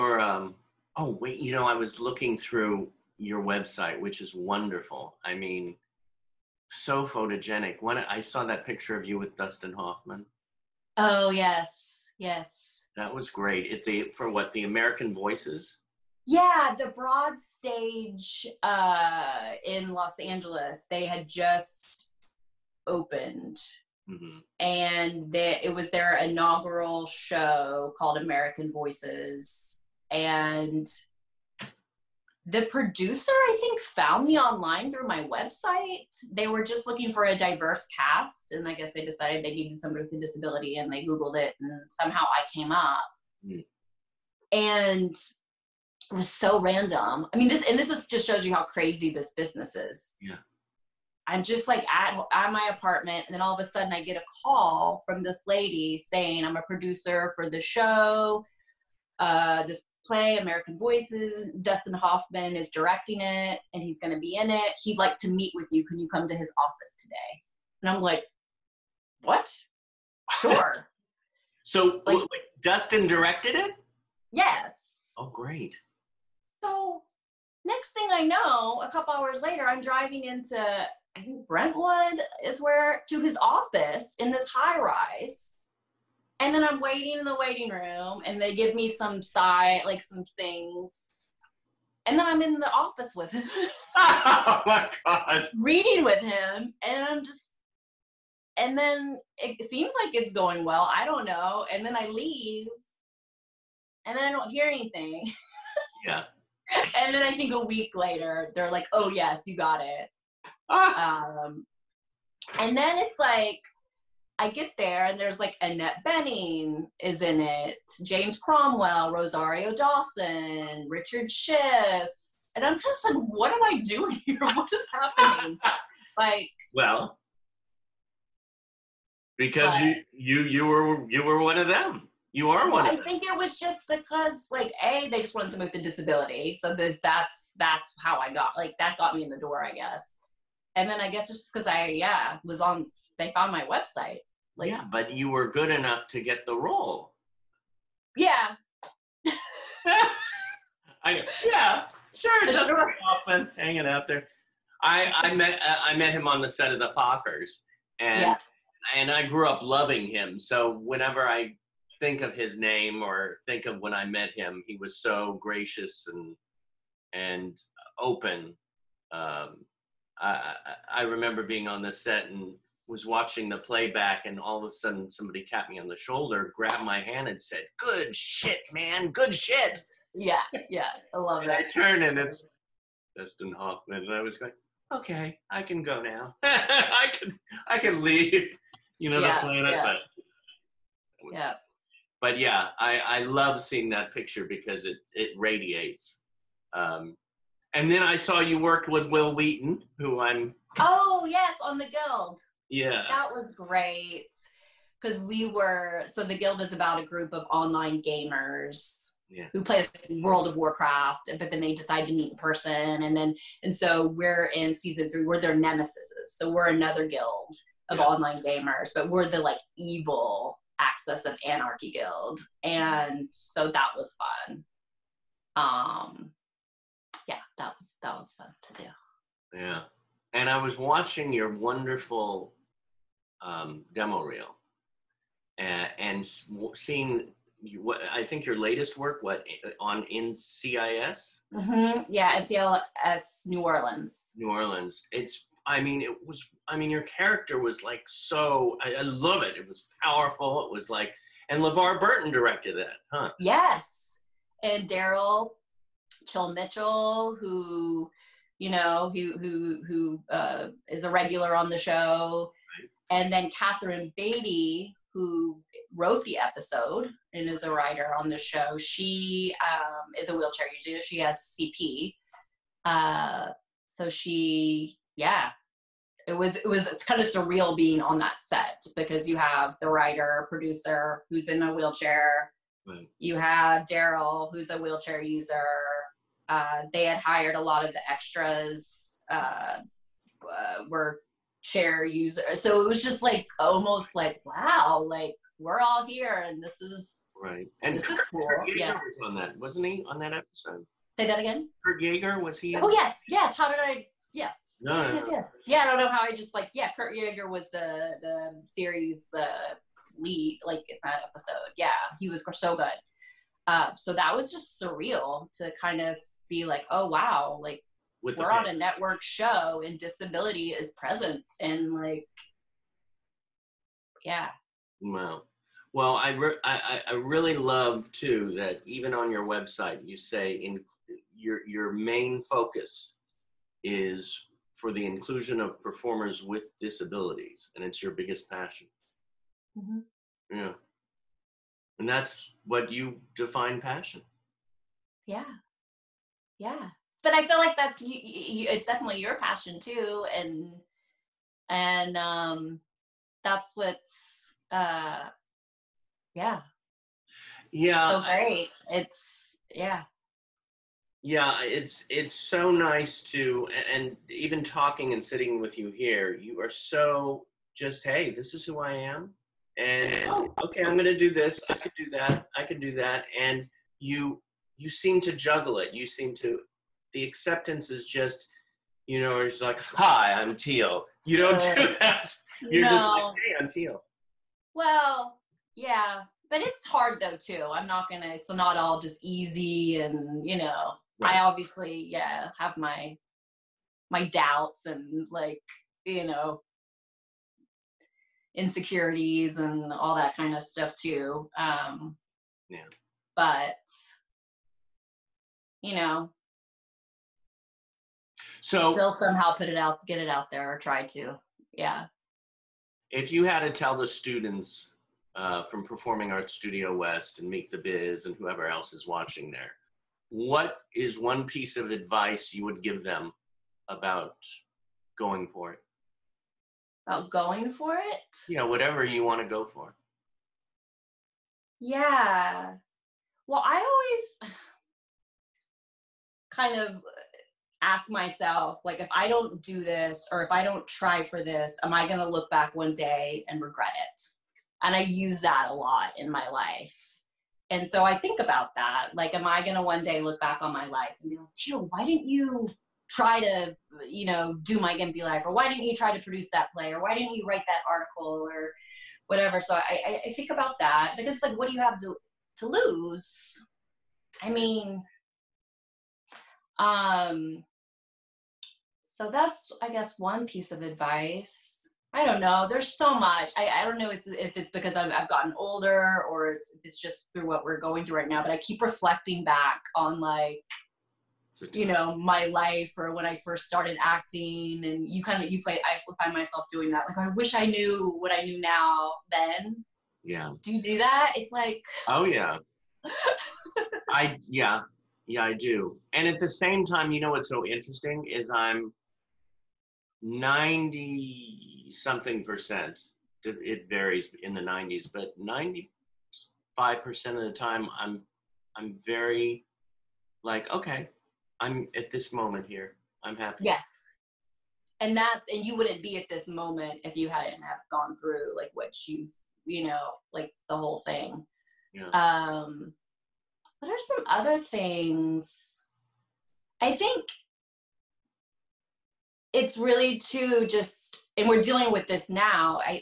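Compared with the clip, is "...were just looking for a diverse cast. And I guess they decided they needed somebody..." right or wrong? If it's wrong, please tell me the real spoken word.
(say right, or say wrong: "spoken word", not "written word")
right.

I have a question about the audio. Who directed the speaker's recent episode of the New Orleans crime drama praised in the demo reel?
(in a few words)
LeVar Burton.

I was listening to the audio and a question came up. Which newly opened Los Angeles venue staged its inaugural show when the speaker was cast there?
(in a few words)
The Broad Stage.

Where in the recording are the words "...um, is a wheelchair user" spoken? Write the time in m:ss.
4:29.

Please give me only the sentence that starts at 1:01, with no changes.
Dustin Hoffman is directing it, and he's going to be in it.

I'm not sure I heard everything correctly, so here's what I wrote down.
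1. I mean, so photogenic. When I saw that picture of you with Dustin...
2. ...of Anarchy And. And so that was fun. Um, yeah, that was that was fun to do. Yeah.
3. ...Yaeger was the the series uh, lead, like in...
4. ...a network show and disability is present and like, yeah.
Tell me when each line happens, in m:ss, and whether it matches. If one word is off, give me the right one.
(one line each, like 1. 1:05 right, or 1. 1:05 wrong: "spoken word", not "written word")
1. 0:05 right
2. 3:41 wrong: "Guild", not "And"
3. 5:07 right
4. 5:18 right.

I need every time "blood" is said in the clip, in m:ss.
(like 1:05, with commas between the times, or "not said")
not said.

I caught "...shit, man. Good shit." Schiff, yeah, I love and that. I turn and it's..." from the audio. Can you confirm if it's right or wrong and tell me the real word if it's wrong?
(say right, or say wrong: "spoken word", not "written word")
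wrong: "Yeah", not "Schiff".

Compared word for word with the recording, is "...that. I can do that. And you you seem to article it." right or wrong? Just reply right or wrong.
wrong.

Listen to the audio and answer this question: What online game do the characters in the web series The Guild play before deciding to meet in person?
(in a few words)
World of Warcraft.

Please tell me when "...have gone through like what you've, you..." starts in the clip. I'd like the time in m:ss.
8:37.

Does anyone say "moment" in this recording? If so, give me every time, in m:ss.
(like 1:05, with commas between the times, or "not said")
8:32, 8:36.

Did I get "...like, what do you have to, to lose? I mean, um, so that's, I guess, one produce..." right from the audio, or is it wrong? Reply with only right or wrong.
wrong.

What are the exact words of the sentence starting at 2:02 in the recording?
And I'm kind of like, what am I doing here?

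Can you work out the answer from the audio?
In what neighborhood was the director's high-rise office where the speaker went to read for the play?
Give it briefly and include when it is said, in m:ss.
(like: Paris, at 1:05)
Brentwood, at 1:21.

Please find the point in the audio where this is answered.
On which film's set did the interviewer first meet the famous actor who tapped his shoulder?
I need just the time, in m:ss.
2:36.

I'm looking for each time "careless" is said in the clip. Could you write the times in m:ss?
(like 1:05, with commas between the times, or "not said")
not said.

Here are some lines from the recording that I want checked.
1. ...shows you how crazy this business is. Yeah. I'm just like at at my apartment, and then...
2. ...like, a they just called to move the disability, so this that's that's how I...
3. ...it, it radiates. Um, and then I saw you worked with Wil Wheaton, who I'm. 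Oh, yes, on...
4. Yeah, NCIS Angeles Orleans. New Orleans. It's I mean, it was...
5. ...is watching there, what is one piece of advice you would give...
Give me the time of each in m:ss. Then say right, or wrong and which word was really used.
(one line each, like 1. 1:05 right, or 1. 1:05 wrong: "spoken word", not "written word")
1. 0:48 right
2. 2:14 wrong: "wanted", not "called"
3. 3:14 right
4. 4:02 wrong: "New", not "Angeles"
5. 6:58 right.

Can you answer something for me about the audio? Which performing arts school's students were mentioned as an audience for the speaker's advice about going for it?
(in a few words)
Performing Arts Studio West.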